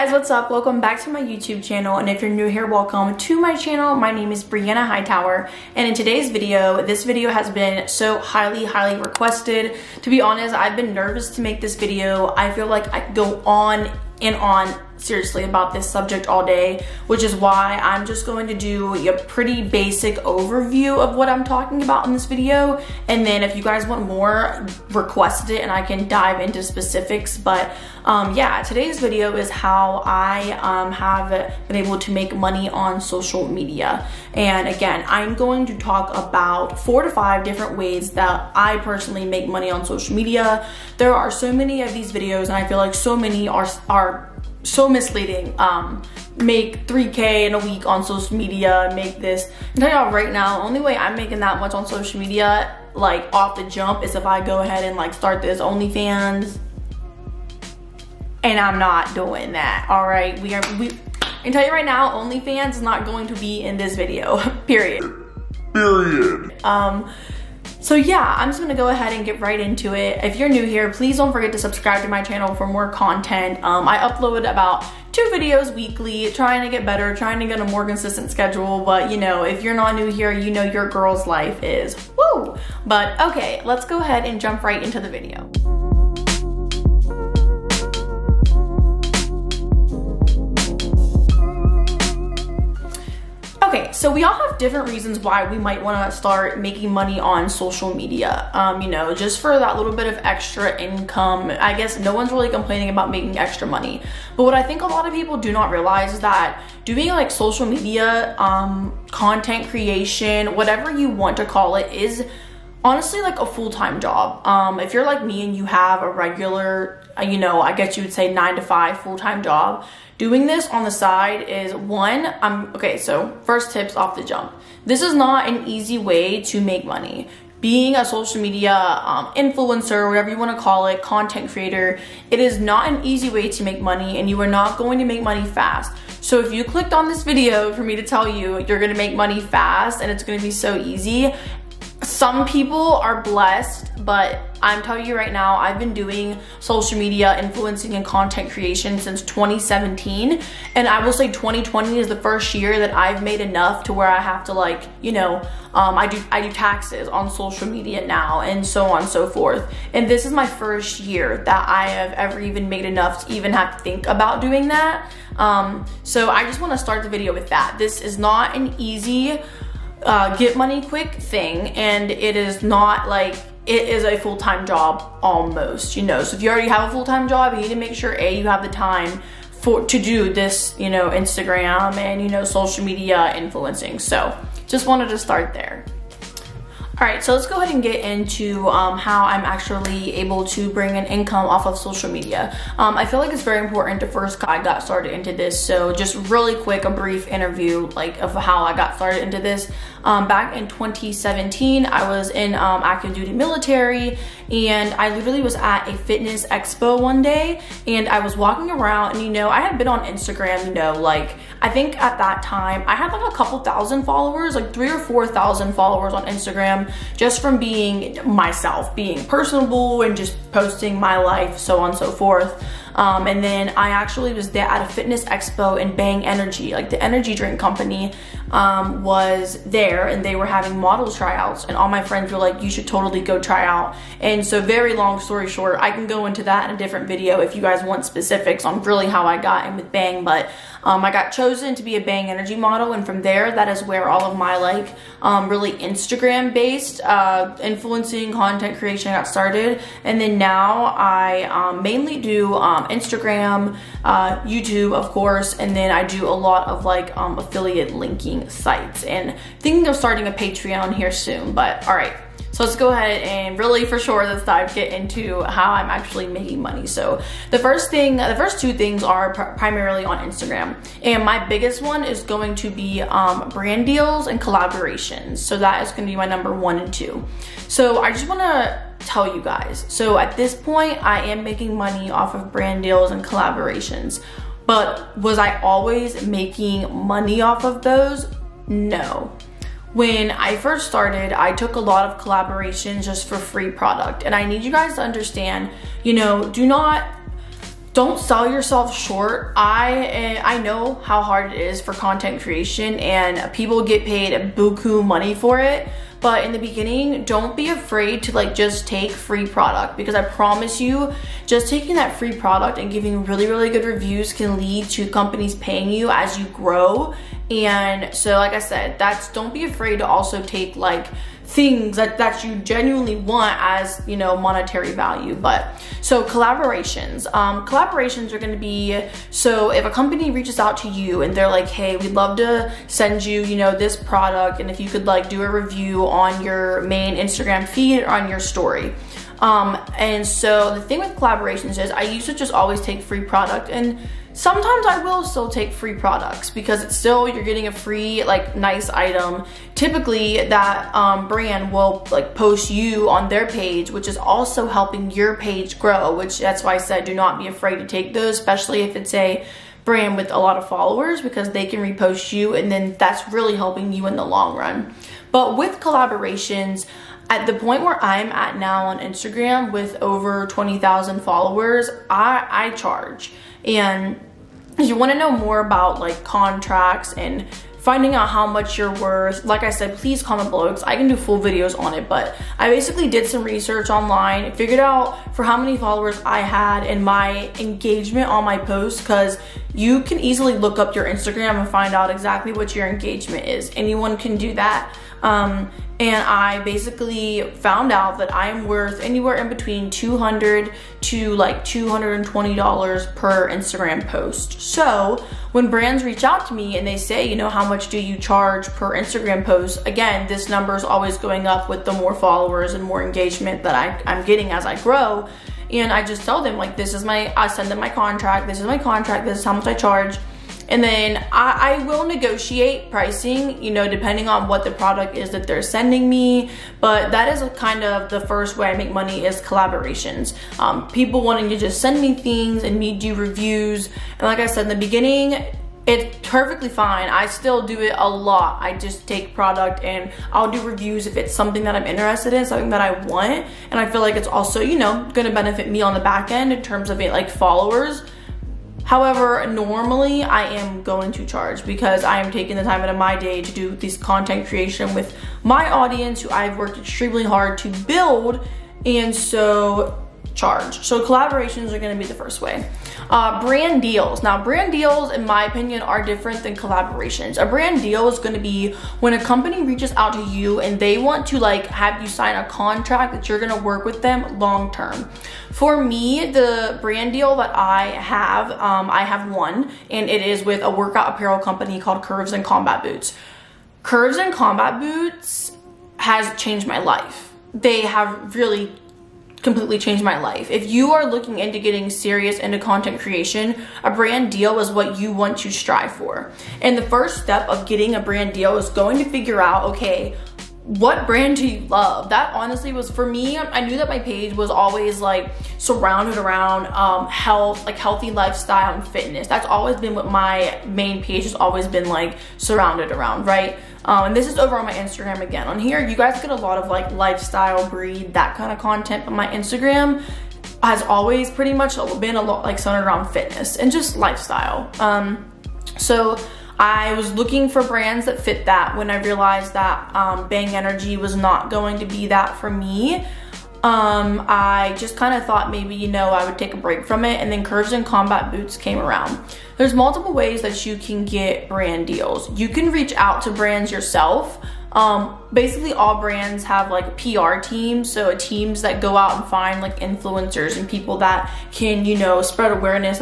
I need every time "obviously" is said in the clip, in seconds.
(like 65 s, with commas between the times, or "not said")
not said.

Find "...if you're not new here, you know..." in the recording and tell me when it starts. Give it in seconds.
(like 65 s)
79 s.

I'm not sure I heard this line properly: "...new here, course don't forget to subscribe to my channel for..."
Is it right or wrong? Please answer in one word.
wrong.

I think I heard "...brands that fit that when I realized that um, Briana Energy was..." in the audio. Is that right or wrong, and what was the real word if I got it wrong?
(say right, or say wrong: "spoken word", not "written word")
wrong: "Bang", not "Briana".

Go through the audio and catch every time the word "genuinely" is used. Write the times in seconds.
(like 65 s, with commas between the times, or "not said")
322 s.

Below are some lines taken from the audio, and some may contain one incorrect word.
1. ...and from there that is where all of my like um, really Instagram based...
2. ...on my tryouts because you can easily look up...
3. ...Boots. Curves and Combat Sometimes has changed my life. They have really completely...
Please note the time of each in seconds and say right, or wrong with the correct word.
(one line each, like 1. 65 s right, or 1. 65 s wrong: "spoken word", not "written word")
1. 242 s right
2. 388 s wrong: "posts", not "tryouts"
3. 482 s wrong: "Boots", not "Sometimes".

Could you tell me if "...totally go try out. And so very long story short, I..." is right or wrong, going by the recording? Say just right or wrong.
right.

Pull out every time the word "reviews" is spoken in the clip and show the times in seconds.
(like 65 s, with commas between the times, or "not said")
313 s, 335 s, 433 s, 440 s.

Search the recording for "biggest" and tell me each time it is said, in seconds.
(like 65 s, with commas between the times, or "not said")
271 s.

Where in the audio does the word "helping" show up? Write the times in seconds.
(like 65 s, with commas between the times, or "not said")
354 s, 363 s.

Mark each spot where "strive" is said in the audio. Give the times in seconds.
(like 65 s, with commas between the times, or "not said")
495 s.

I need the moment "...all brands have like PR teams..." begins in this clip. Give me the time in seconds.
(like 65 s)
545 s.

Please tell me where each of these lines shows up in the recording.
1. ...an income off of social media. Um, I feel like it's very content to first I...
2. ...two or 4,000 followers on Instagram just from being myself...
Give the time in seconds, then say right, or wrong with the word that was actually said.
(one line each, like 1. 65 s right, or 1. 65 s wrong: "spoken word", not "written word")
1. 190 s wrong: "important", not "content"
2. 214 s wrong: "three", not "two".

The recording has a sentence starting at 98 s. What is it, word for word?
Um, you know, just for that little bit of extra income.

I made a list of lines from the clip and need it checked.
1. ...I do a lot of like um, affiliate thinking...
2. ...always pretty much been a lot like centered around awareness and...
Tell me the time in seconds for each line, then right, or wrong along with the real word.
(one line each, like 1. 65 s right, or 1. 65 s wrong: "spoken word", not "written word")
1. 255 s wrong: "linking", not "thinking"
2. 520 s wrong: "fitness", not "awareness".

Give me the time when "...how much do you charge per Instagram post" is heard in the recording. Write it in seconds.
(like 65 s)
407 s.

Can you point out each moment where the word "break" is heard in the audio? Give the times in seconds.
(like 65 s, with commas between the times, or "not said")
536 s.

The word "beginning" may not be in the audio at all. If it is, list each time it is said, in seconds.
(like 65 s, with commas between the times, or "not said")
306 s, 434 s.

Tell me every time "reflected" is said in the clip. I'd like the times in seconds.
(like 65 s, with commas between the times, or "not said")
not said.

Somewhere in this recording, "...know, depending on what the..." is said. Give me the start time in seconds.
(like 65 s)
423 s.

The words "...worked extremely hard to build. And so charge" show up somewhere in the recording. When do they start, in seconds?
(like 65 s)
456 s.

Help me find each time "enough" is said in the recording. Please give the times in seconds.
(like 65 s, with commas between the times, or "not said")
153 s, 162 s.